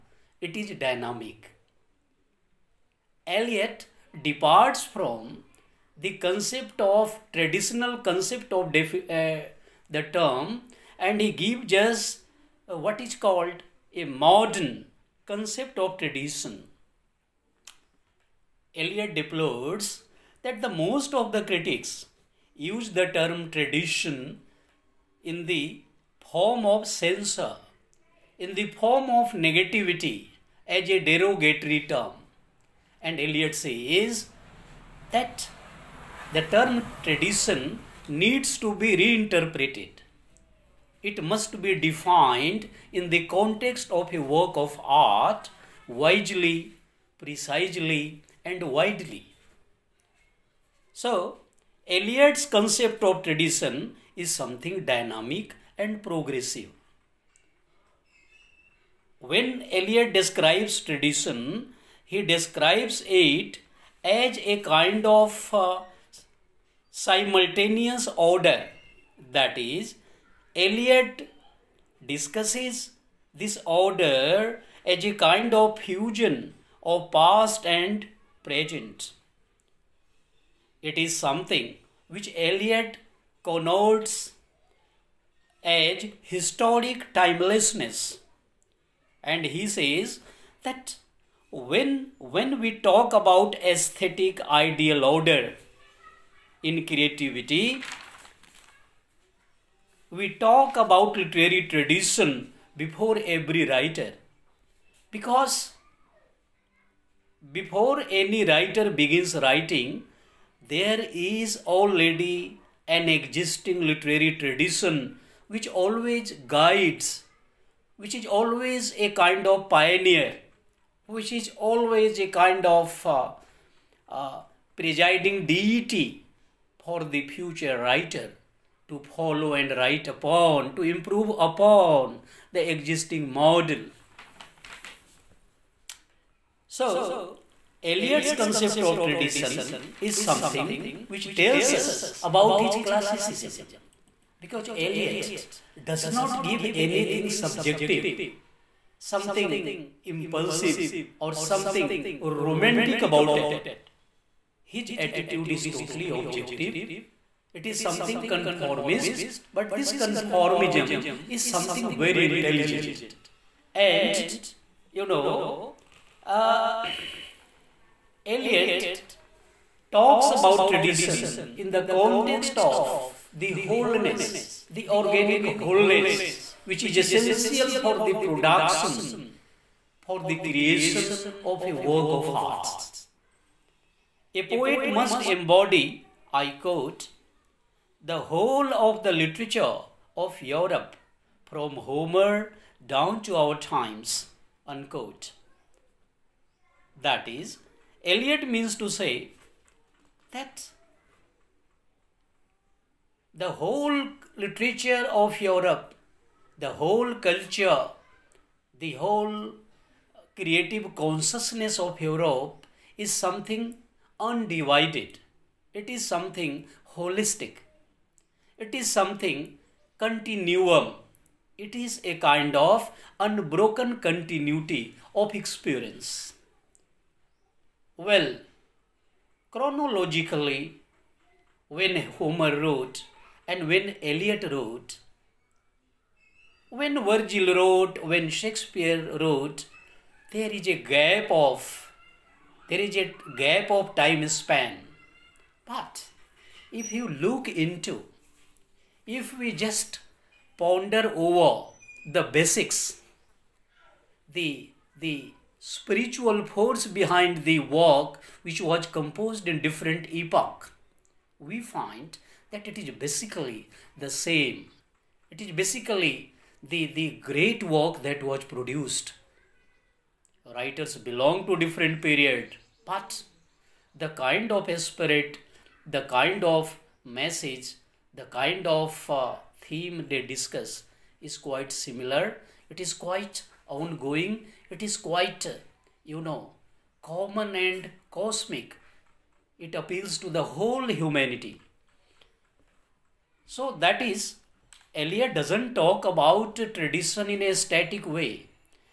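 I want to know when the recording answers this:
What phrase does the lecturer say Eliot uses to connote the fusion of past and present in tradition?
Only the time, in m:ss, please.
1:26.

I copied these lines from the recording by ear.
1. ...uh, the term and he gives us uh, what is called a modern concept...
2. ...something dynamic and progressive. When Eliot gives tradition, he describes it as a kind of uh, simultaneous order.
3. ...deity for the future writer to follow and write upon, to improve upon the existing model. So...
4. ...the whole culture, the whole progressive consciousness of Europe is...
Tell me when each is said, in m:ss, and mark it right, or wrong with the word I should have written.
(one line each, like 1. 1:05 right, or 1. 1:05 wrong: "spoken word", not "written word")
1. 0:08 right
2. 0:54 wrong: "describes", not "gives"
3. 2:05 right
4. 3:26 wrong: "creative", not "progressive".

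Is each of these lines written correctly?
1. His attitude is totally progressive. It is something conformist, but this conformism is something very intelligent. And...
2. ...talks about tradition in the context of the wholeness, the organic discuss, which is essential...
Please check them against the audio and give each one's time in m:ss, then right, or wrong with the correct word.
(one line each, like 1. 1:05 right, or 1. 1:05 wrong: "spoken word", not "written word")
1. 2:34 wrong: "objective", not "progressive"
2. 2:49 wrong: "wholeness", not "discuss".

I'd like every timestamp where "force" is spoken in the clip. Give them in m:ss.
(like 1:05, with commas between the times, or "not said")
4:16.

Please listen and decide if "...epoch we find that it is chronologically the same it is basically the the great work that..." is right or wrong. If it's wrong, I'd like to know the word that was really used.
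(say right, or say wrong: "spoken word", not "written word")
wrong: "basically", not "chronologically".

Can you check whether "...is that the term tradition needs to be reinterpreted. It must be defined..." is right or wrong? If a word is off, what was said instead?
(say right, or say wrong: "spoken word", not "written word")
right.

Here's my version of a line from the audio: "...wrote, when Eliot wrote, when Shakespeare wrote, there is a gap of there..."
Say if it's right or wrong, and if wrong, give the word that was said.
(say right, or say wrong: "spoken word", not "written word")
wrong: "Virgil", not "Eliot".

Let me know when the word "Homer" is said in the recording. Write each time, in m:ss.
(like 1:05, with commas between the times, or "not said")
3:11, 3:52.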